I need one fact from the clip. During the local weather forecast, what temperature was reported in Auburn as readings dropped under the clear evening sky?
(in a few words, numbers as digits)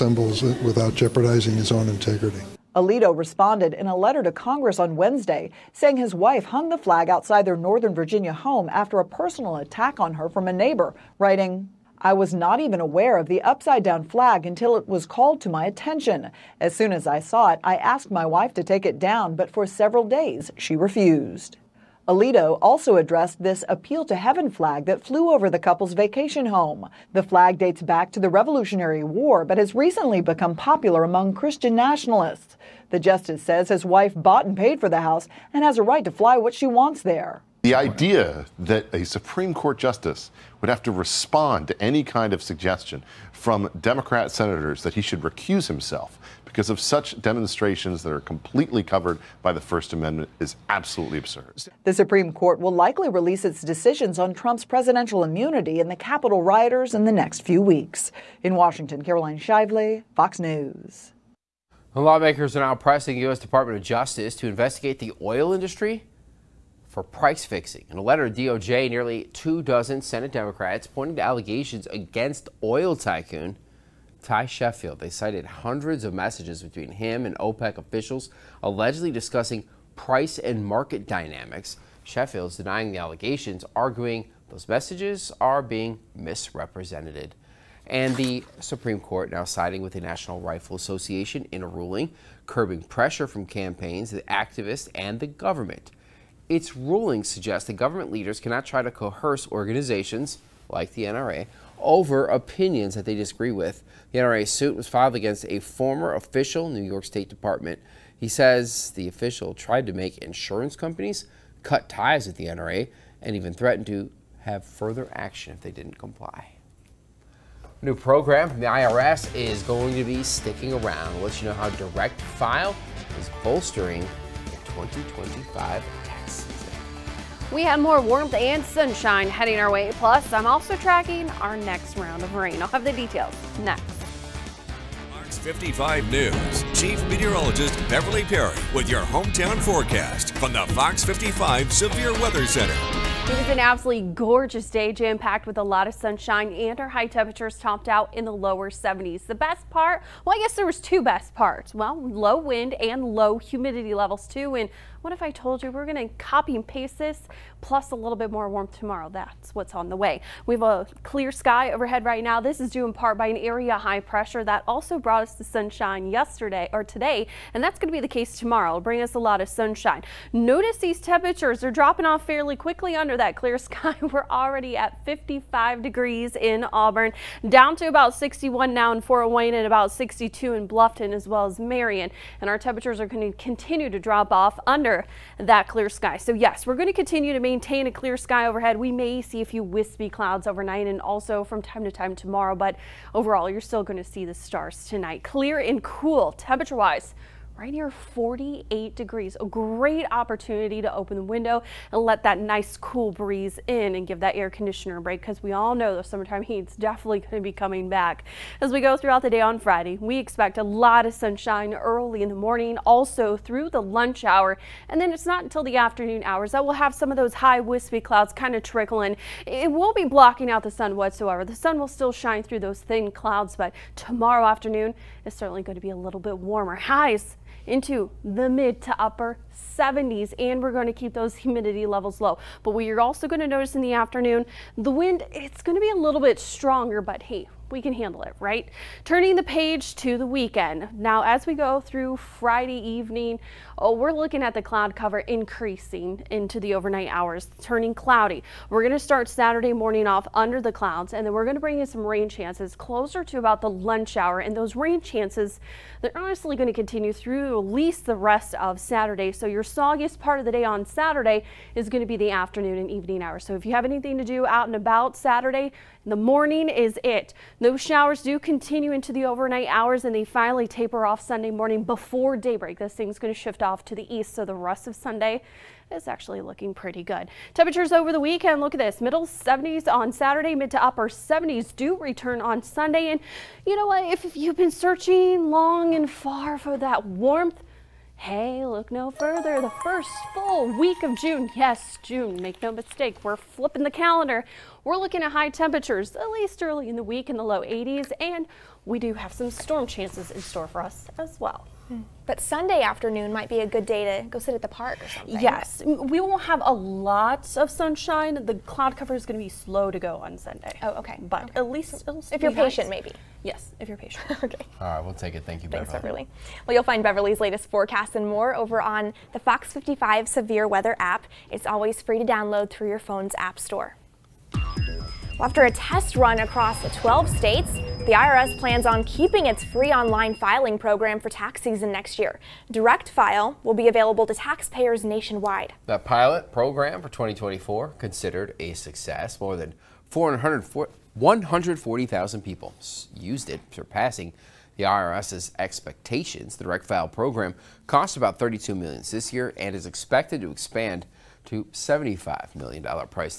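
55 degrees.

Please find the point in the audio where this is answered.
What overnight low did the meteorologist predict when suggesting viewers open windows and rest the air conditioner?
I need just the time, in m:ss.
3:17.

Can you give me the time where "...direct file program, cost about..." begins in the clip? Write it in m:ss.
5:46.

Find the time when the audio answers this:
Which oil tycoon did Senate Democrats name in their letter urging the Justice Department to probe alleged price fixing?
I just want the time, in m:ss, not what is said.
1:14.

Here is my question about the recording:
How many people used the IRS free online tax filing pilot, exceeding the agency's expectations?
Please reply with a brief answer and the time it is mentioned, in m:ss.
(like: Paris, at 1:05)
More than 140,000, at 5:39.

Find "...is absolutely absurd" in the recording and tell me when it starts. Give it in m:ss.
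0:50.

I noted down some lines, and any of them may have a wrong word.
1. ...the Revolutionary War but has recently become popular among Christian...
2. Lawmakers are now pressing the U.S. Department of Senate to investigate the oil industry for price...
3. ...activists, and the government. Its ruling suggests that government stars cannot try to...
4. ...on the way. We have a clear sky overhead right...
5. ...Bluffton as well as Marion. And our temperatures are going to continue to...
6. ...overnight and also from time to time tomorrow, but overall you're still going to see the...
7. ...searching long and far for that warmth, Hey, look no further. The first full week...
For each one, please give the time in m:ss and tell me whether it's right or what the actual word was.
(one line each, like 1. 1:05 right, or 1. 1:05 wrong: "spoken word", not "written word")
1. 0:28 right
2. 1:02 wrong: "Justice", not "Senate"
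3. 1:34 wrong: "leaders", not "stars"
4. 2:39 right
5. 3:00 right
6. 3:10 right
7. 4:44 right.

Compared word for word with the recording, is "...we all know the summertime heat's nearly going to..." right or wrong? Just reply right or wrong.
wrong.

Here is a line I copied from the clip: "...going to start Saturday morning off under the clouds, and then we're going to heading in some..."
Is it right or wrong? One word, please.
wrong.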